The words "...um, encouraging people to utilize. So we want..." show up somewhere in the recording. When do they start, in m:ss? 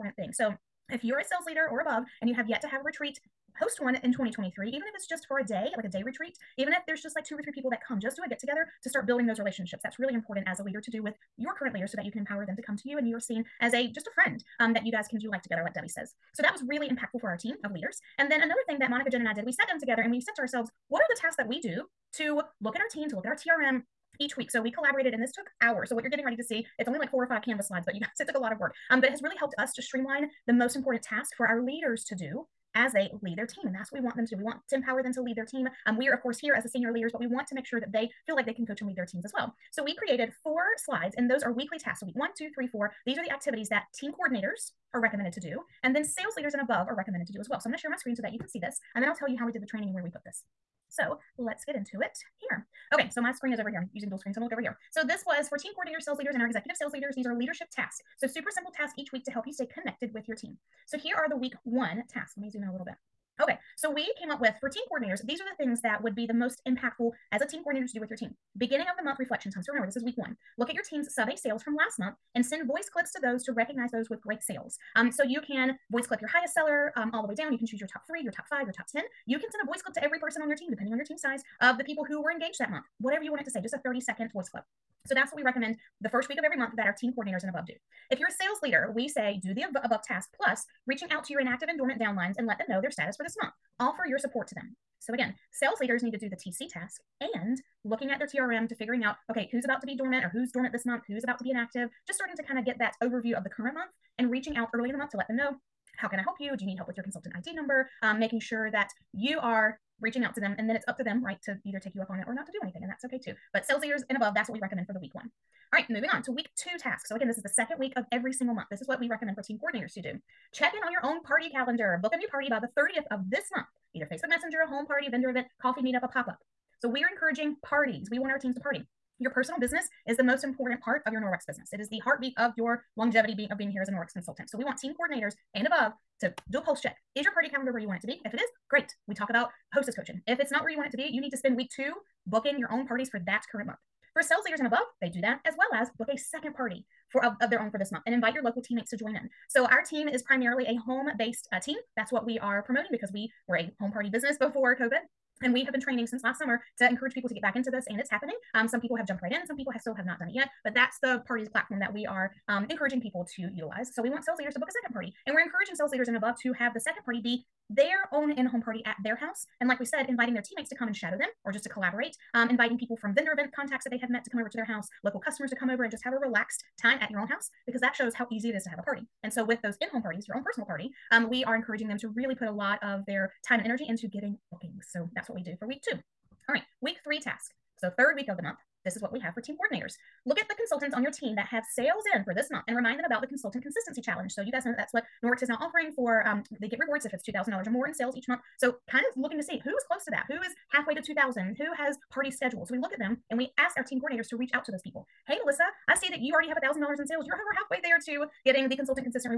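2:42.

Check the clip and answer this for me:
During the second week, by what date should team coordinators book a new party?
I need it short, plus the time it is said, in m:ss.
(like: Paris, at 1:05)
the 30th, at 2:02.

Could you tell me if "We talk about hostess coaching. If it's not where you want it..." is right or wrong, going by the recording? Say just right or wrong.
right.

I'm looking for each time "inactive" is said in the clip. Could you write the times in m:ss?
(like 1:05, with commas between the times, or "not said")
1:31, 1:41.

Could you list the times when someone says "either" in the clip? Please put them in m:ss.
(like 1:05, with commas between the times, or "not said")
1:51, 2:03.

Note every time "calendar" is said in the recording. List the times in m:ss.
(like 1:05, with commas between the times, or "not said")
2:01, 2:17.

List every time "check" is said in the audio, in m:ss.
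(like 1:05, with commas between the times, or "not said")
2:00, 2:16.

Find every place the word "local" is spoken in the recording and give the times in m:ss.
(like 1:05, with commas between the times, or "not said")
2:28, 2:55.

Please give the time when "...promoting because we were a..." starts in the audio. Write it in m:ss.
2:32.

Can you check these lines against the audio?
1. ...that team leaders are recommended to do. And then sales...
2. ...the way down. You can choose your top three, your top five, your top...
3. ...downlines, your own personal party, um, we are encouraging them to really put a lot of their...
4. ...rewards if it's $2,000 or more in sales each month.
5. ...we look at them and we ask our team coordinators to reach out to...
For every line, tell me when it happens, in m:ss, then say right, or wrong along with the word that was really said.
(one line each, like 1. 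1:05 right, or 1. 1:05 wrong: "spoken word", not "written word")
1. 0:43 wrong: "coordinators", not "leaders"
2. 1:17 right
3. 3:00 wrong: "parties", not "downlines"
4. 3:16 right
5. 3:22 right.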